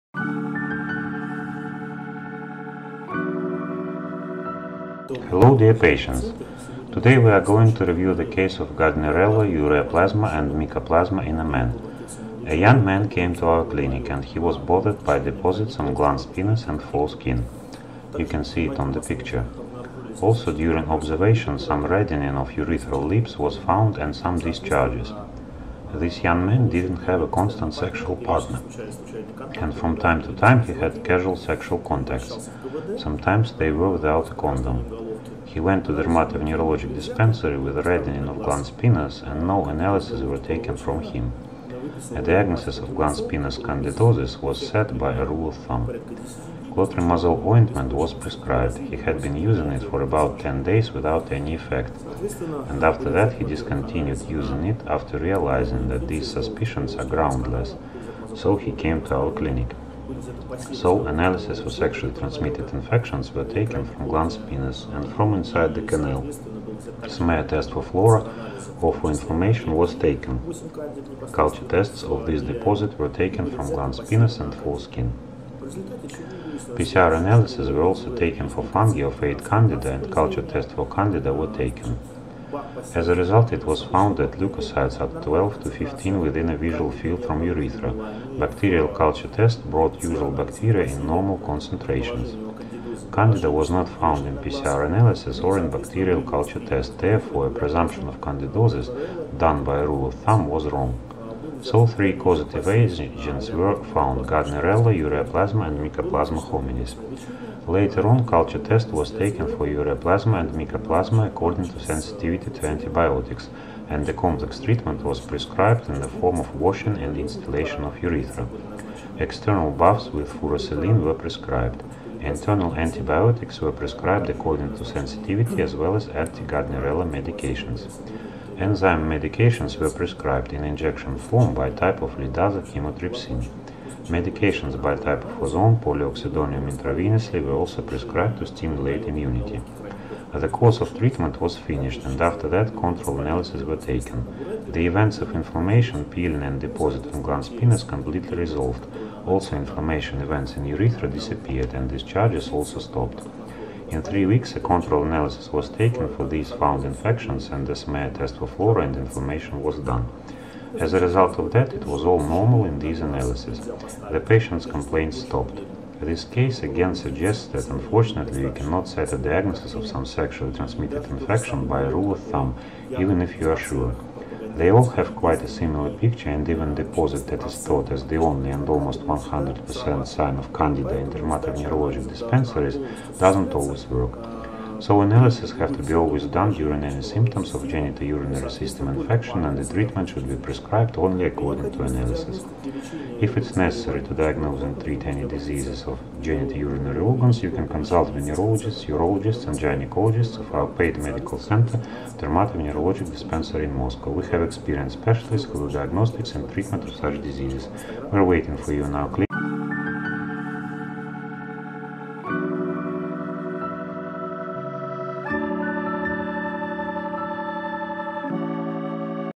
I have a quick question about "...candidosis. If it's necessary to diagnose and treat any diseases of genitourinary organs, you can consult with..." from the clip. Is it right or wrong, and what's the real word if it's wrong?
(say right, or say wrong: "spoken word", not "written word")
wrong: "analysis", not "candidosis".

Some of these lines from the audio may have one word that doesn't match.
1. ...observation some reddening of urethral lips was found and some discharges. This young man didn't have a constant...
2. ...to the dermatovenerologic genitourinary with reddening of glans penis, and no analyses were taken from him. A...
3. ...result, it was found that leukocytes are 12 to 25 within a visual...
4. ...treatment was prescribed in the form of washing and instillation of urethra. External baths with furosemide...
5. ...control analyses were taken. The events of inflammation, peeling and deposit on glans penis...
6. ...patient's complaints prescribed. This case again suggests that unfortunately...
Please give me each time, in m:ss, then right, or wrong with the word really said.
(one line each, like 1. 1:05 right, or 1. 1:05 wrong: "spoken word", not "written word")
1. 0:20 right
2. 0:35 wrong: "dispensary", not "genitourinary"
3. 1:23 wrong: "15", not "25"
4. 1:54 right
5. 2:22 right
6. 2:44 wrong: "stopped", not "prescribed".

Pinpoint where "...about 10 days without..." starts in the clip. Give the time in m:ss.
0:50.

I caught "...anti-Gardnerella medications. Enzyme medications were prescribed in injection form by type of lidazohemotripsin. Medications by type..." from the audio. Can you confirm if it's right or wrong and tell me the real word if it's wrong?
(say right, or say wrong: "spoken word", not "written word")
right.